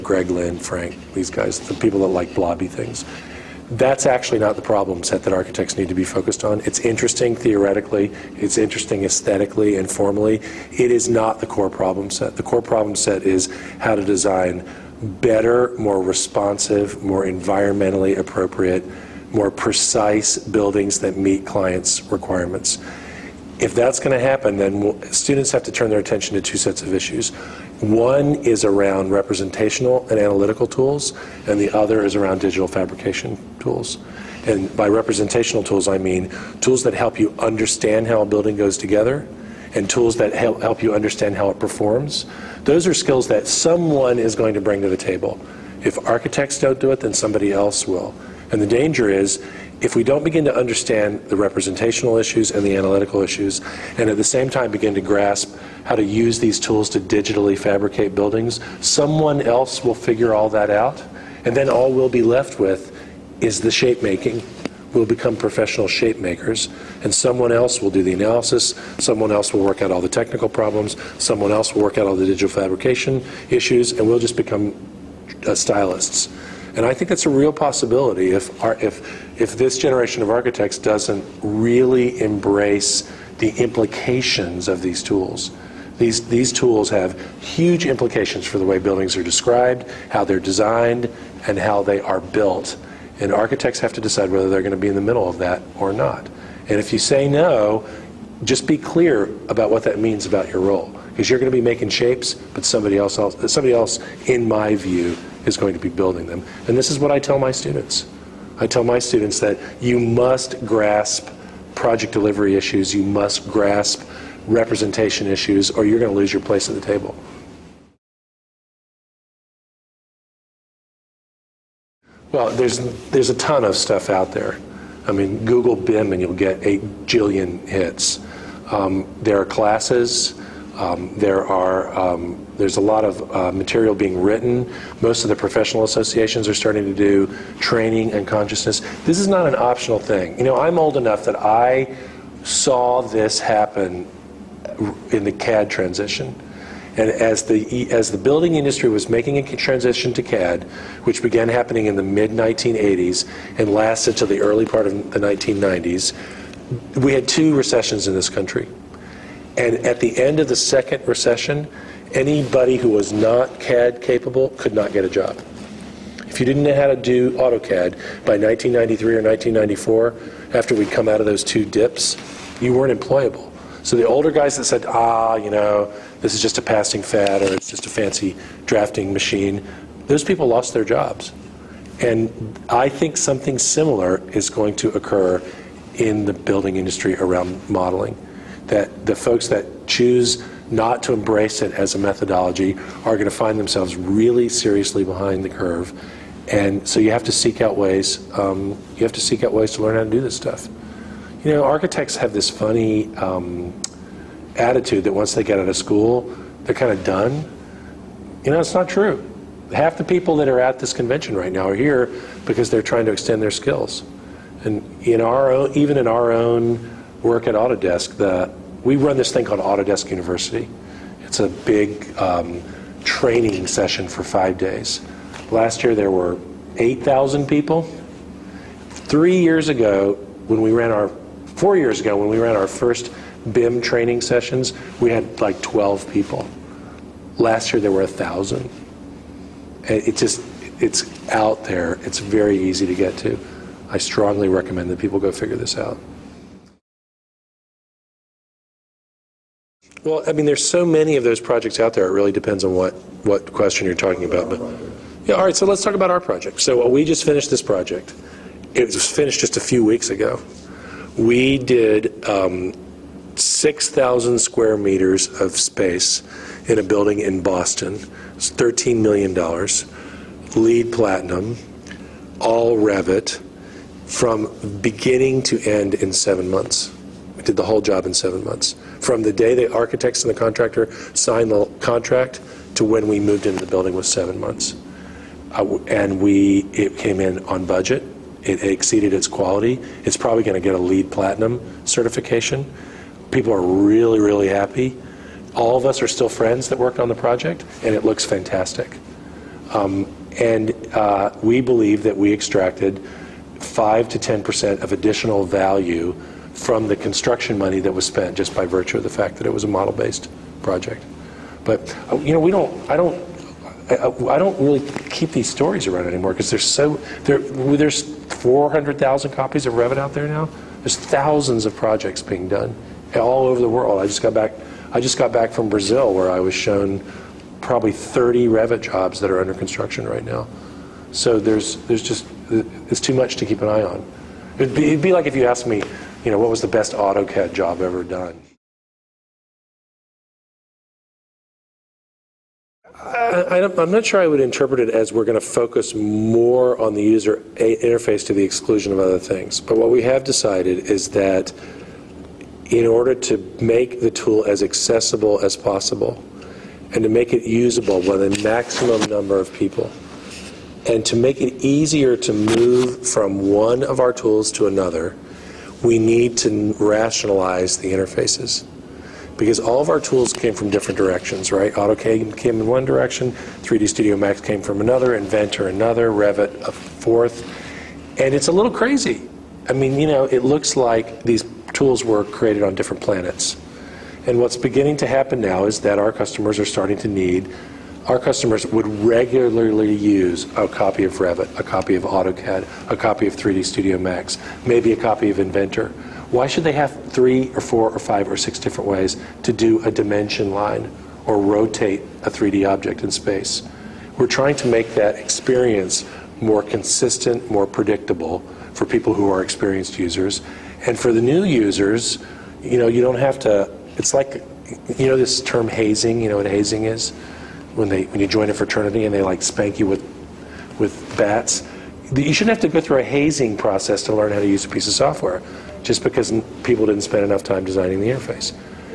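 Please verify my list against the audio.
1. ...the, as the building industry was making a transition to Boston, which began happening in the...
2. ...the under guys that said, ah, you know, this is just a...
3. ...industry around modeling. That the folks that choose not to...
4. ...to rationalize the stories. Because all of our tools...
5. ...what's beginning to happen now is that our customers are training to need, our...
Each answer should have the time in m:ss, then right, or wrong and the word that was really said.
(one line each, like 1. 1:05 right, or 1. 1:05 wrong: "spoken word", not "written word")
1. 2:27 wrong: "CAD", not "Boston"
2. 2:53 wrong: "older", not "under"
3. 3:06 right
4. 6:06 wrong: "interfaces", not "stories"
5. 6:24 wrong: "starting", not "training".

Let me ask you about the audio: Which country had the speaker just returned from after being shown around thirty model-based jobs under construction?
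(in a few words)
Brazil.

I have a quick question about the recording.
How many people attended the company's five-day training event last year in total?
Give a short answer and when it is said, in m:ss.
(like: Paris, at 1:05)
8,000, at 3:46.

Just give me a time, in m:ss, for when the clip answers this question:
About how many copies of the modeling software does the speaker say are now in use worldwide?
5:18.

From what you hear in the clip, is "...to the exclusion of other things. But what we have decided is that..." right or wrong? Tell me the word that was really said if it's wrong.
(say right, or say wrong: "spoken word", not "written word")
right.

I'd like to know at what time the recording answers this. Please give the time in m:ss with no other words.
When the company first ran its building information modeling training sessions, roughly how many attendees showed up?
3:55.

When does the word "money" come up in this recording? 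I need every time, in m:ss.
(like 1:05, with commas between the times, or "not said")
5:07.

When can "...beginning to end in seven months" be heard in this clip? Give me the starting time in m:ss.
4:34.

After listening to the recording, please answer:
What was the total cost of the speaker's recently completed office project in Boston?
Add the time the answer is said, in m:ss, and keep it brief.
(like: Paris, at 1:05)
$13 million, at 4:28.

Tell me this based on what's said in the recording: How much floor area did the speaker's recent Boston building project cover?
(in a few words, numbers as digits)
6,000 square meters.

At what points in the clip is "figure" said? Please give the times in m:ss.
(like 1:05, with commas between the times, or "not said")
0:59, 4:05.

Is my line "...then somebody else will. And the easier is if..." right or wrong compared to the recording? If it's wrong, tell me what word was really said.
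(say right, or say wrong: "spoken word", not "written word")
wrong: "danger", not "easier".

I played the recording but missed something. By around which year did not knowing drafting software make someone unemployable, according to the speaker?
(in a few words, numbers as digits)
1993.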